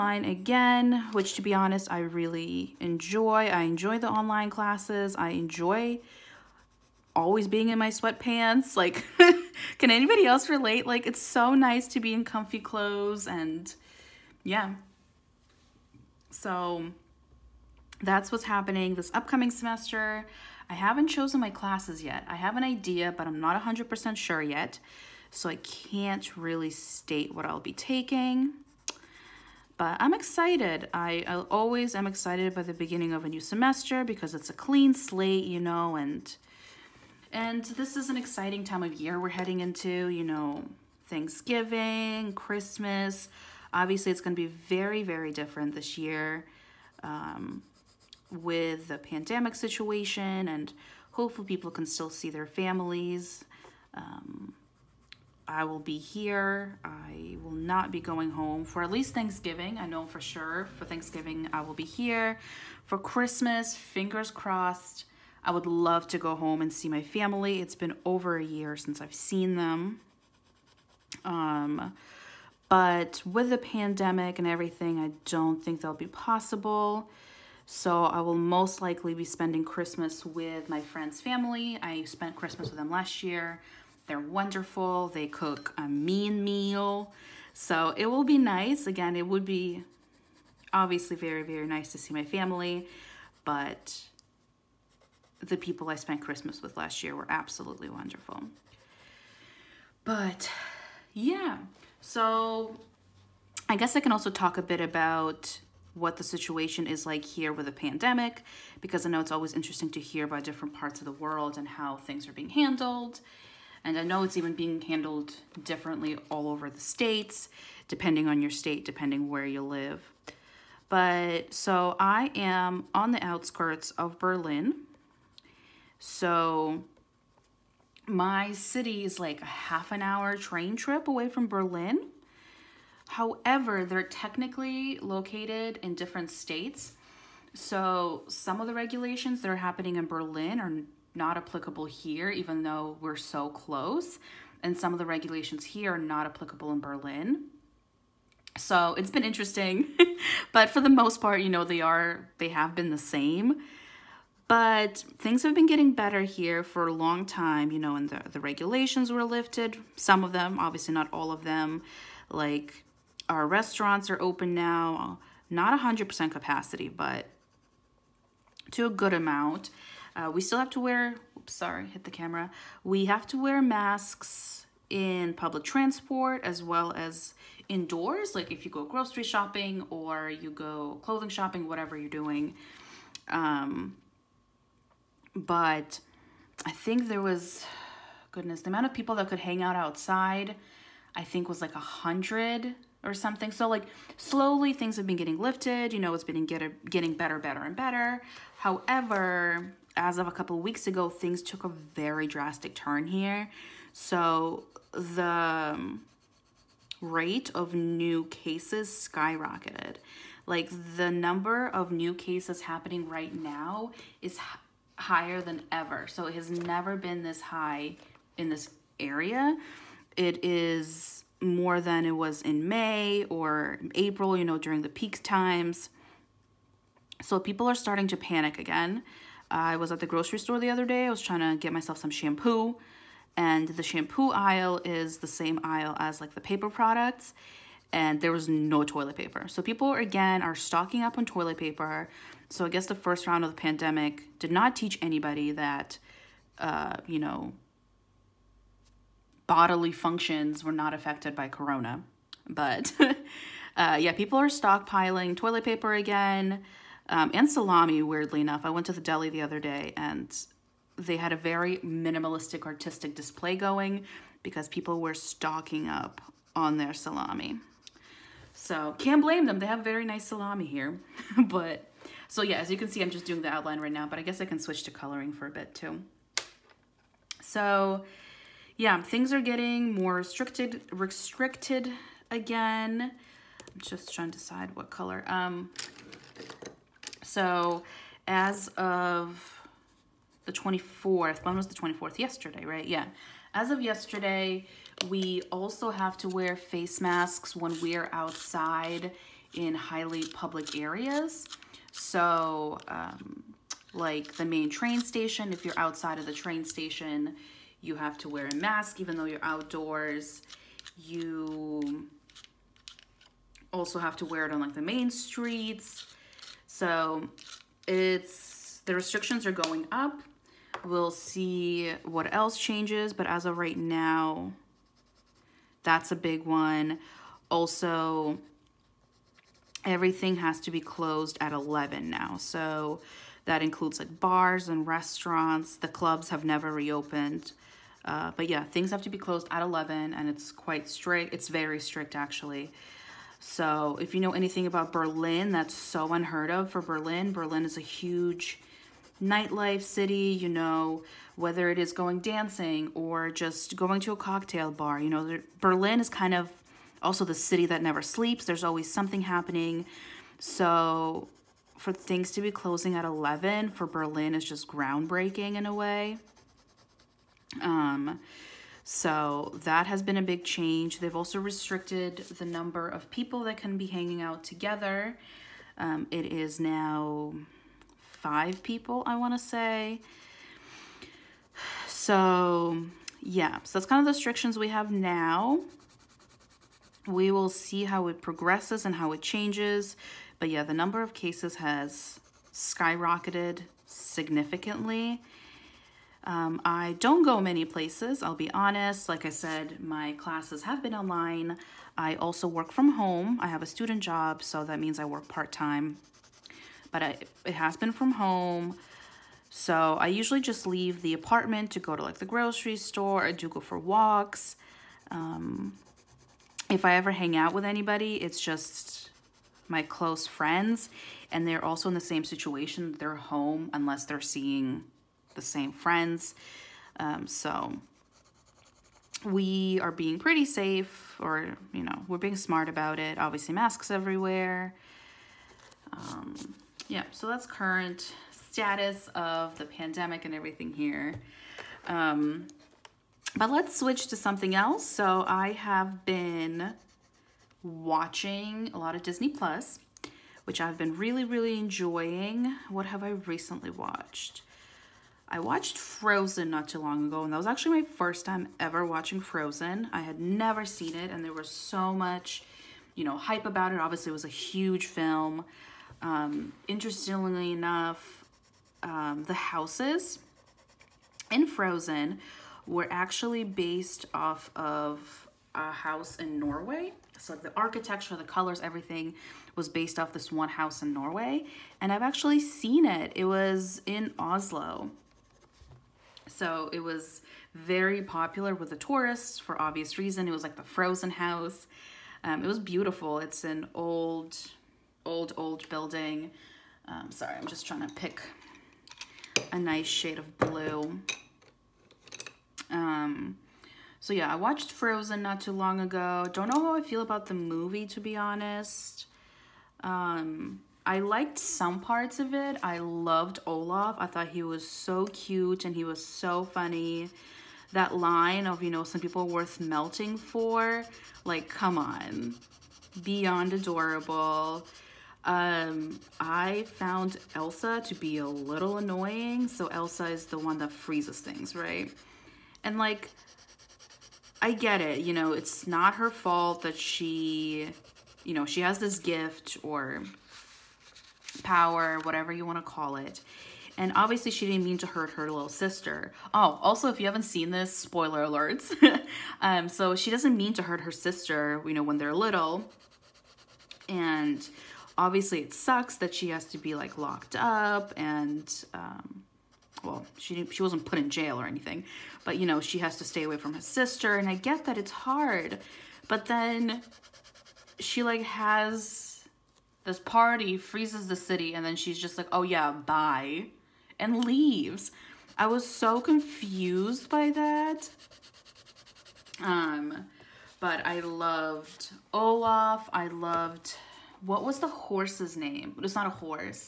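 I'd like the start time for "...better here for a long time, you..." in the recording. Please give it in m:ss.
2:35.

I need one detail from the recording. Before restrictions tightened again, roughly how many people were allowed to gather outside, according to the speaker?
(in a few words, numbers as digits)
100.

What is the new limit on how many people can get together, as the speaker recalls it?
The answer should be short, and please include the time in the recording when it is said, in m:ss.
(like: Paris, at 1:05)
5, at 6:17.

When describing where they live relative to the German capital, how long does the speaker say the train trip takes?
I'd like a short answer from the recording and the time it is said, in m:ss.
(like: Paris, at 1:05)
half an hour, at 2:09.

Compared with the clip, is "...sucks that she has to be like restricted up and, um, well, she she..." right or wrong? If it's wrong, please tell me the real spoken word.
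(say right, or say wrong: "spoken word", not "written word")
wrong: "locked", not "restricted".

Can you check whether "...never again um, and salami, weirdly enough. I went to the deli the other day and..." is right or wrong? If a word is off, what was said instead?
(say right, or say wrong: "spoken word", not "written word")
wrong: "paper", not "never".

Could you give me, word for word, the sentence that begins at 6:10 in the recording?
They've also restricted the number of people that can be hanging out together.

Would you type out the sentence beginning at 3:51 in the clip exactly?
I was trying to get myself some shampoo.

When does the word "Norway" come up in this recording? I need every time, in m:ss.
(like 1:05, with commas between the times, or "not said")
7:56, 8:00.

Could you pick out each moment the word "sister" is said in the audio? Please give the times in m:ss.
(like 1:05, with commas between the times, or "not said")
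9:05, 9:10, 9:23.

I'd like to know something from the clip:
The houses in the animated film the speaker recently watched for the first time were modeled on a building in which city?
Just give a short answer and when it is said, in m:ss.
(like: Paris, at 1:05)
Oslo, at 8:04.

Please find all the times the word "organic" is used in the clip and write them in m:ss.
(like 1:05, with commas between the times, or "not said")
not said.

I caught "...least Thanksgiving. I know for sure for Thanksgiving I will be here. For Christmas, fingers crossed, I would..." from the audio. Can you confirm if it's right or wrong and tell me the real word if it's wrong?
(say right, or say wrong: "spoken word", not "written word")
right.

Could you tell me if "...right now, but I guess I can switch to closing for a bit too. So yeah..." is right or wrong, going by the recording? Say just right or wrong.
wrong.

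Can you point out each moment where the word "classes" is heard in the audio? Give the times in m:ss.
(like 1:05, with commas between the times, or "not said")
0:04, 0:21, 6:40.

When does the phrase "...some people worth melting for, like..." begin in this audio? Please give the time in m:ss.
8:38.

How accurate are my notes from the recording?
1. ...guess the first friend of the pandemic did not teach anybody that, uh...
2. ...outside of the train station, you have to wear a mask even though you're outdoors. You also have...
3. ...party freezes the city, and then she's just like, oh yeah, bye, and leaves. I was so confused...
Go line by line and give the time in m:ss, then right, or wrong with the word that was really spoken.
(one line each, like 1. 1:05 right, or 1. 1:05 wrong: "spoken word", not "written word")
1. 4:02 wrong: "round", not "friend"
2. 5:05 right
3. 9:29 right.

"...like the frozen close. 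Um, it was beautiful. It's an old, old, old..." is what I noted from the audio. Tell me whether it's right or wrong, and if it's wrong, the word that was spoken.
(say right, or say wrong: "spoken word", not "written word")
wrong: "house", not "close".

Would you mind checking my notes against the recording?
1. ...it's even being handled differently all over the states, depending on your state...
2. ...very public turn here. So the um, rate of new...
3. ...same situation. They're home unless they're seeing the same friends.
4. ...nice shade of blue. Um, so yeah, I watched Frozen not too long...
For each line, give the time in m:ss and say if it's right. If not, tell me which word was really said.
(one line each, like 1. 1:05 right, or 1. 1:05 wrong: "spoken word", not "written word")
1. 1:54 right
2. 3:21 wrong: "drastic", not "public"
3. 7:01 right
4. 8:19 right.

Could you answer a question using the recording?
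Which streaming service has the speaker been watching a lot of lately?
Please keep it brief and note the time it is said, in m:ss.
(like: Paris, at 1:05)
Disney Plus, at 7:29.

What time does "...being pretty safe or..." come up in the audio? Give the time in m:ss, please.
7:09.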